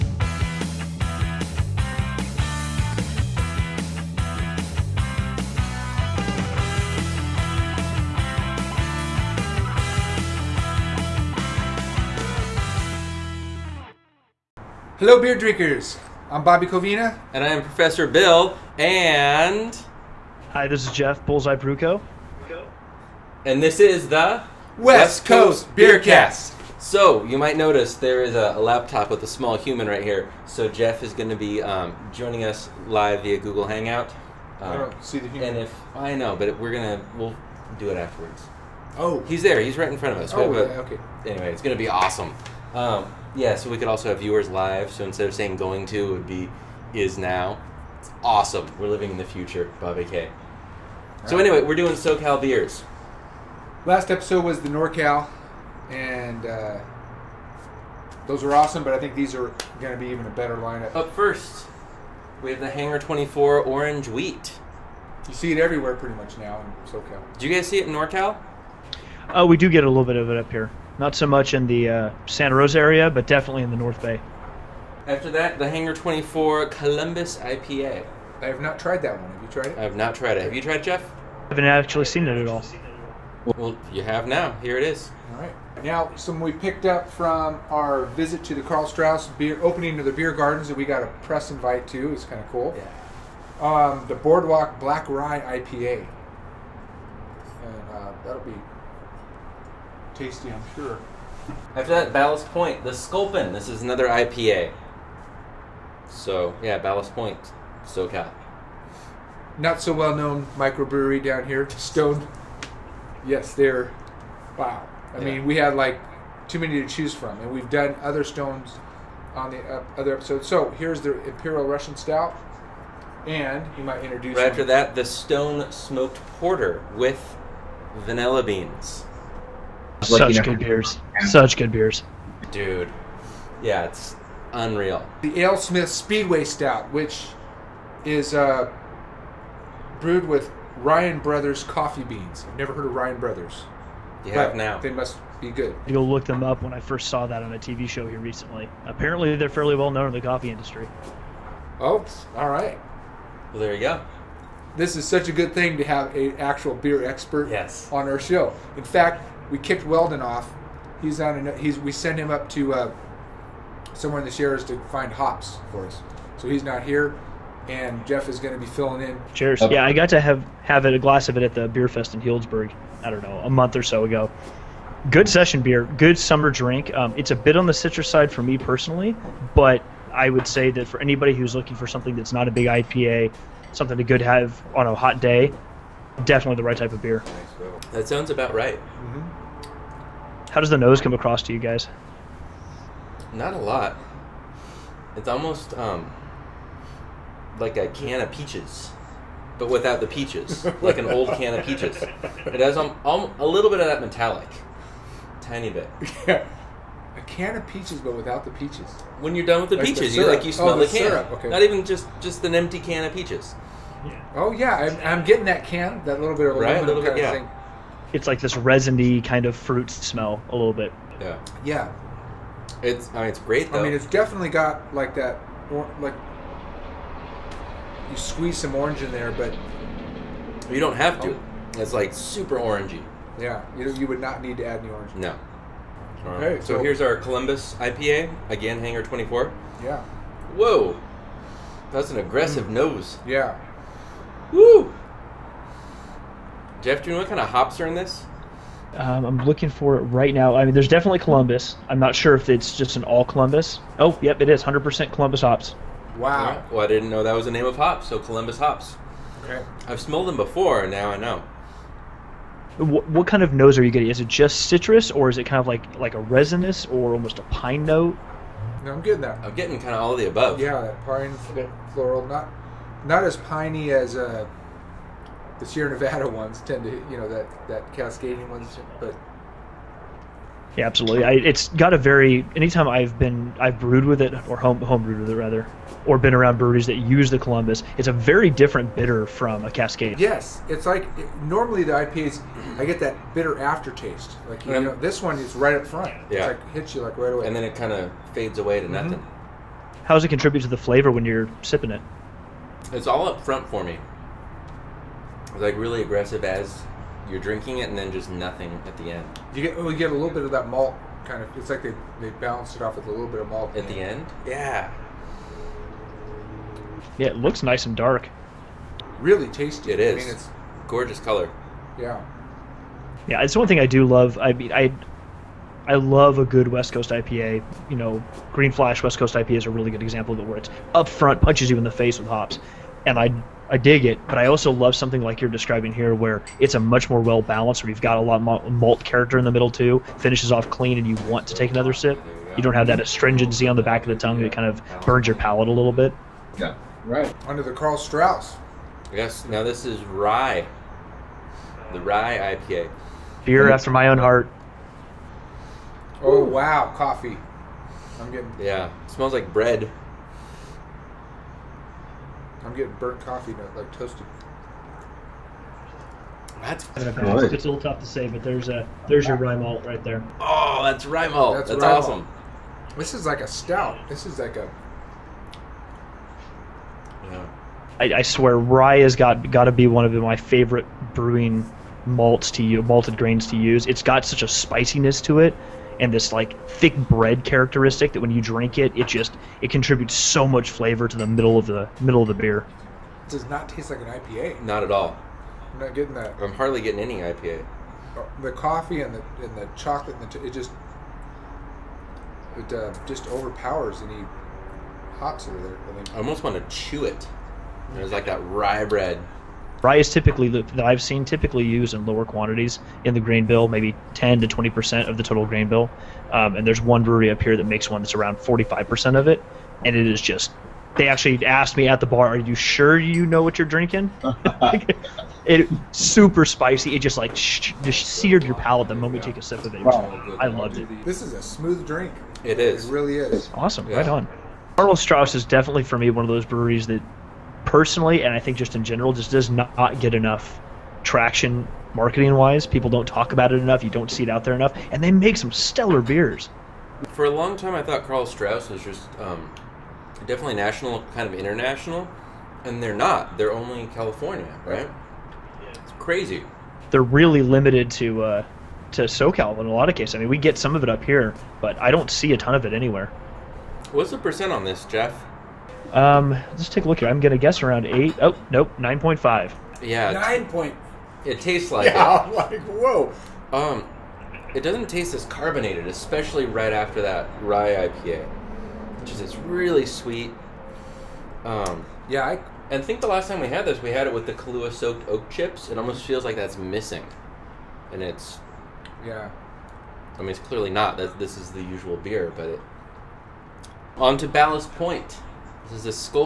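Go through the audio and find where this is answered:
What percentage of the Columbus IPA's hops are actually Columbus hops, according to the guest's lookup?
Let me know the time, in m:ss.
4:14.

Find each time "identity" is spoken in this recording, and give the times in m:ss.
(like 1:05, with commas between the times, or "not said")
not said.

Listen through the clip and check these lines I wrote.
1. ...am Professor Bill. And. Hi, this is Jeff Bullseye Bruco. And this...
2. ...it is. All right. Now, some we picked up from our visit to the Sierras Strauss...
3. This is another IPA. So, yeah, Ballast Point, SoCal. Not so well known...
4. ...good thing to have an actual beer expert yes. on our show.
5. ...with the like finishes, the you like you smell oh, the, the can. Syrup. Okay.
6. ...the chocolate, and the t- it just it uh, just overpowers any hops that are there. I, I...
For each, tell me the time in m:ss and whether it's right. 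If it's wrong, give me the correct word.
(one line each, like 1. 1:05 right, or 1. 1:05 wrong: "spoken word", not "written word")
1. 0:17 right
2. 1:24 wrong: "Karl", not "Sierras"
3. 1:43 right
4. 2:35 right
5. 3:29 wrong: "peaches", not "finishes"
6. 6:39 right.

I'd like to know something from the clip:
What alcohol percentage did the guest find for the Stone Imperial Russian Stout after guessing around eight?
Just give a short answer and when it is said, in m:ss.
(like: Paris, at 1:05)
9.5, at 7:48.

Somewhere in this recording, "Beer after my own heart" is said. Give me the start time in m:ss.
5:53.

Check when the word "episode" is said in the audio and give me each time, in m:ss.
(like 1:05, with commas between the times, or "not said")
0:54, 2:00.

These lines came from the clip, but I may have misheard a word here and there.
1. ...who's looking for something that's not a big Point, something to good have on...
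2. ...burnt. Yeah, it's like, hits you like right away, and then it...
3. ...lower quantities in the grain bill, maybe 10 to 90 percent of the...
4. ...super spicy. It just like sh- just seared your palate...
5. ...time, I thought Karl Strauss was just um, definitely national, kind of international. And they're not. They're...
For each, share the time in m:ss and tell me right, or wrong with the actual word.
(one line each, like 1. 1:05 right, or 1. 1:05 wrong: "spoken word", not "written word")
1. 3:01 wrong: "IPA", not "Point"
2. 4:55 wrong: "front", not "burnt"
3. 6:52 wrong: "20", not "90"
4. 7:05 right
5. 7:27 right.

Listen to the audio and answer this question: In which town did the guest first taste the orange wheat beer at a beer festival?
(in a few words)
Healdsburg.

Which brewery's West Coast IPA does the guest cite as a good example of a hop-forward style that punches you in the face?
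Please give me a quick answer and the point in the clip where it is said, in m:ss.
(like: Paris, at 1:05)
Green Flash, at 5:28.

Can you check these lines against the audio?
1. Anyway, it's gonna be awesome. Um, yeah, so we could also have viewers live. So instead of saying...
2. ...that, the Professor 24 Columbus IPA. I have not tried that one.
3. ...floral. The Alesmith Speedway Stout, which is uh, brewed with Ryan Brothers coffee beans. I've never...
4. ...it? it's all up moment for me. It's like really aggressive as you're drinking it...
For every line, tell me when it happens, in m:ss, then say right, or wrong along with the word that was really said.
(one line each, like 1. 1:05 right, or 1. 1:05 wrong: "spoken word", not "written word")
1. 0:41 right
2. 1:15 wrong: "Hangar", not "Professor"
3. 2:14 wrong: "unreal", not "floral"
4. 5:01 wrong: "front", not "moment".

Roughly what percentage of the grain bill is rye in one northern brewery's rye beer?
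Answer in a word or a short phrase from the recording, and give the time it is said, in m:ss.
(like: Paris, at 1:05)
45 percent, at 6:58.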